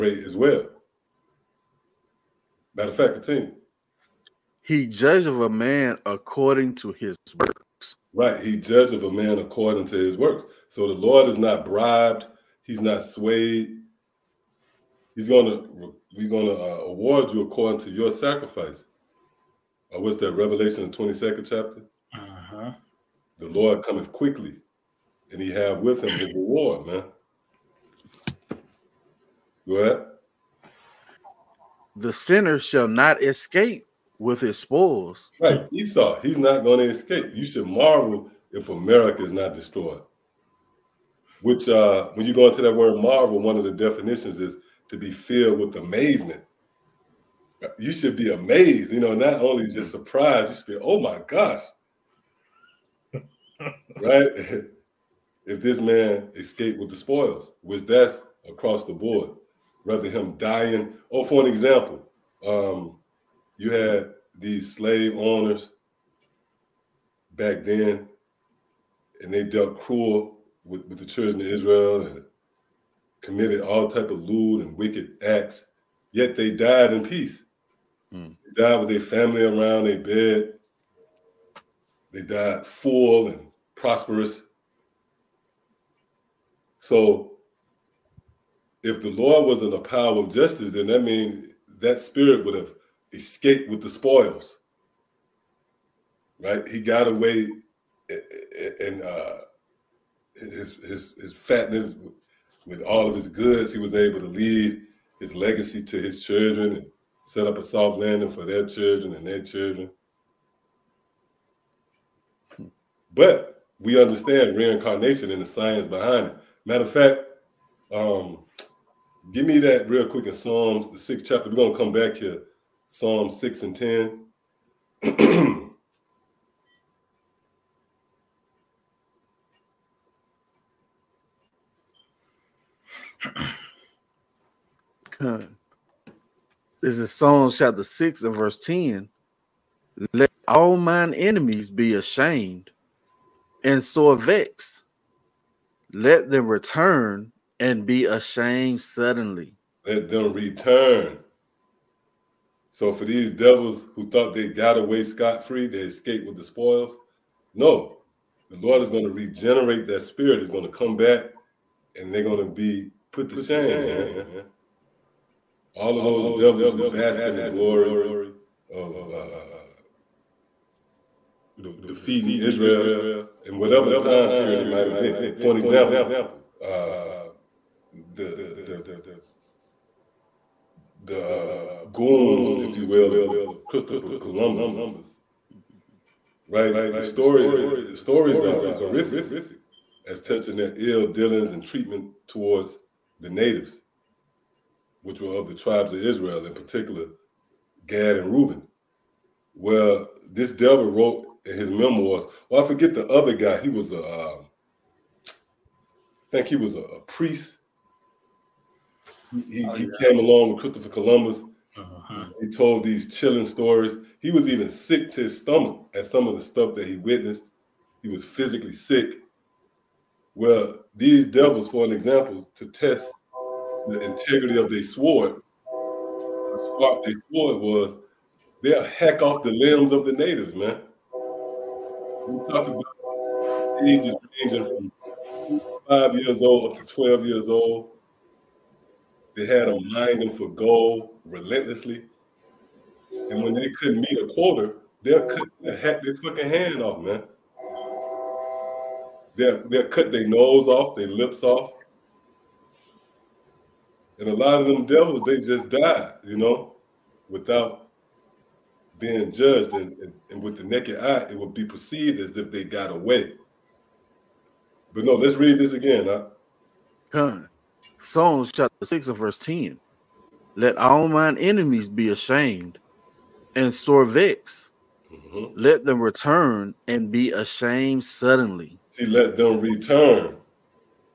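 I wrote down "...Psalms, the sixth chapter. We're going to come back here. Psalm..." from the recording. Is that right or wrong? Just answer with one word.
right.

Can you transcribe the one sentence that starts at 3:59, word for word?
They had them mining for gold relentlessly.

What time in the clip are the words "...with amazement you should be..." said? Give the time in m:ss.
0:45.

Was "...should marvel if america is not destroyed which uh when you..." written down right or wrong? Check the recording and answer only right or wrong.
right.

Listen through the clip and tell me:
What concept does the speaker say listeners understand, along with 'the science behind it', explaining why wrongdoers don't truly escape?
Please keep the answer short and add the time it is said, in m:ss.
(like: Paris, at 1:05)
Reincarnation, at 1:54.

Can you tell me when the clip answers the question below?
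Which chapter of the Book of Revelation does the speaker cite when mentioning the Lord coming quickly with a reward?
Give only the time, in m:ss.
0:20.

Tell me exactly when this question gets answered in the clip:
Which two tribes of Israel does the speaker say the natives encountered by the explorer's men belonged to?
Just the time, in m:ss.
3:17.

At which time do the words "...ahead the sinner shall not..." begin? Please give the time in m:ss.
0:29.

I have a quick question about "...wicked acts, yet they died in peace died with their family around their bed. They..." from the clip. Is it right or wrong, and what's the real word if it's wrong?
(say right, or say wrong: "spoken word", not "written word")
right.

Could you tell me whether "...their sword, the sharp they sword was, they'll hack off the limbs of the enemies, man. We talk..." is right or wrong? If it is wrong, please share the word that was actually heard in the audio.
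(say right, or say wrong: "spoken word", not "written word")
wrong: "natives", not "enemies".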